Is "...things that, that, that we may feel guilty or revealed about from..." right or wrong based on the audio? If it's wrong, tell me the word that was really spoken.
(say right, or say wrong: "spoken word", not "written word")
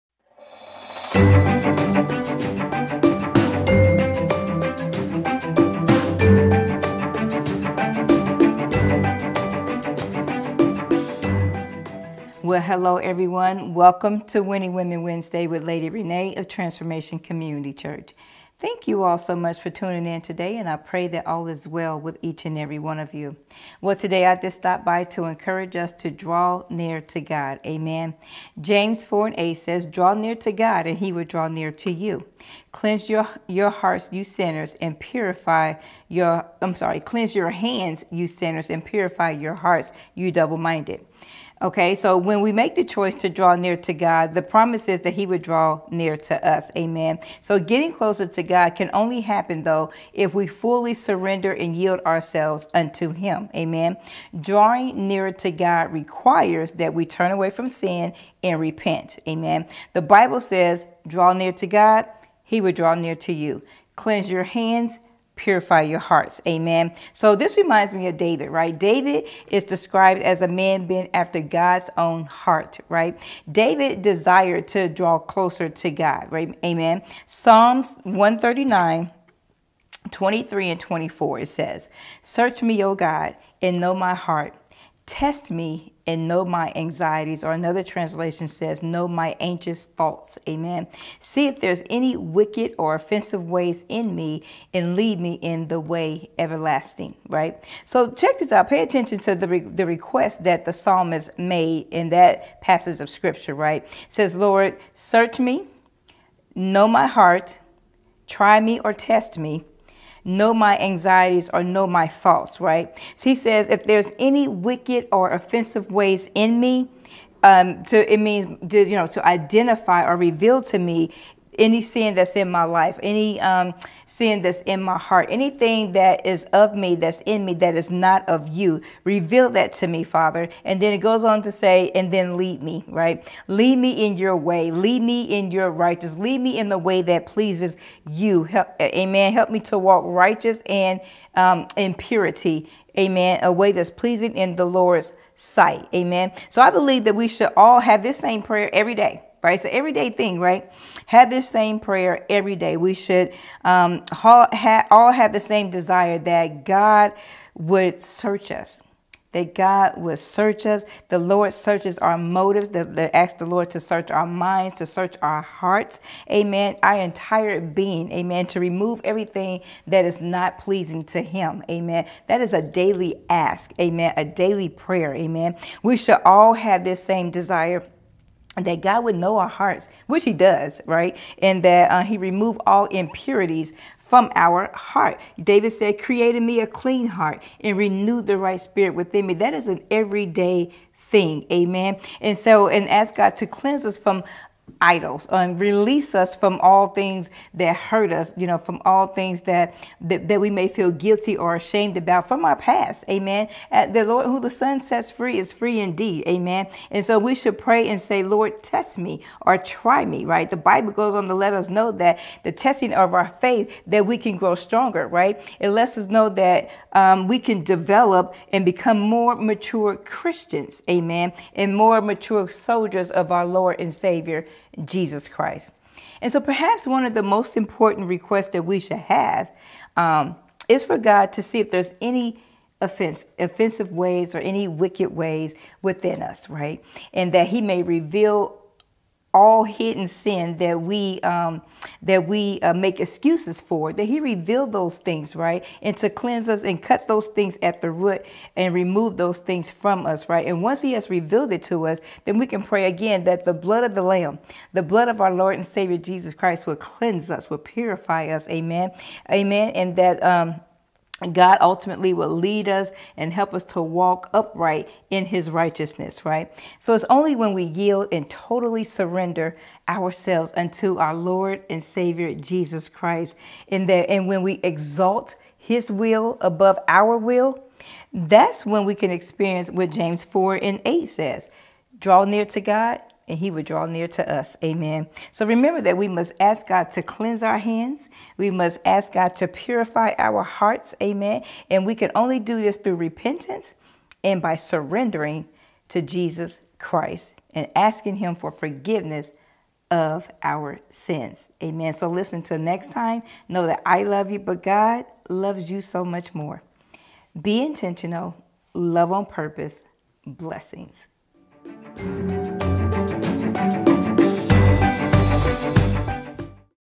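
wrong: "ashamed", not "revealed".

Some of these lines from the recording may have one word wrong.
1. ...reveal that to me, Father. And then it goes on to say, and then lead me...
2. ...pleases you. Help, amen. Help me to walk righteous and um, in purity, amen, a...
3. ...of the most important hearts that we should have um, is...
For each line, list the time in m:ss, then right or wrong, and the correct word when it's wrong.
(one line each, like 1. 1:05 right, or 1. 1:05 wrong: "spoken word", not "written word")
1. 2:09 right
2. 2:17 right
3. 3:47 wrong: "requests", not "hearts".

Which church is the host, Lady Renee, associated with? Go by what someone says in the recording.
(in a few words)
Transformation Community Church.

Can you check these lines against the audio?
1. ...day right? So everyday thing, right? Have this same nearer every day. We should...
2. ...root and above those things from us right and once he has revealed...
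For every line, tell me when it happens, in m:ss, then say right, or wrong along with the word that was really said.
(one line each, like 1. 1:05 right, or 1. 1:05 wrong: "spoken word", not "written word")
1. 2:28 wrong: "prayer", not "nearer"
2. 4:07 wrong: "remove", not "above".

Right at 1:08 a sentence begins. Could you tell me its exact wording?
David is described as a man being after God's own heart, right?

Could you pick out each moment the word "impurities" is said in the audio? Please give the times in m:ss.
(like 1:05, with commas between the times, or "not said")
3:02.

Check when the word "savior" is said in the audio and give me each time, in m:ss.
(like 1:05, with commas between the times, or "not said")
3:43, 4:15, 4:31.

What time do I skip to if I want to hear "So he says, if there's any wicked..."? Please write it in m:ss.
1:53.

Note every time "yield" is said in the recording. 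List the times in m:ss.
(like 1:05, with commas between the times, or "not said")
0:51, 4:27.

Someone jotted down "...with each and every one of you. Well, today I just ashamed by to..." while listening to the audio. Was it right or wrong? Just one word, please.
wrong.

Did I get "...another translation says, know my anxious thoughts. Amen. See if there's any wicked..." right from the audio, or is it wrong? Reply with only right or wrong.
right.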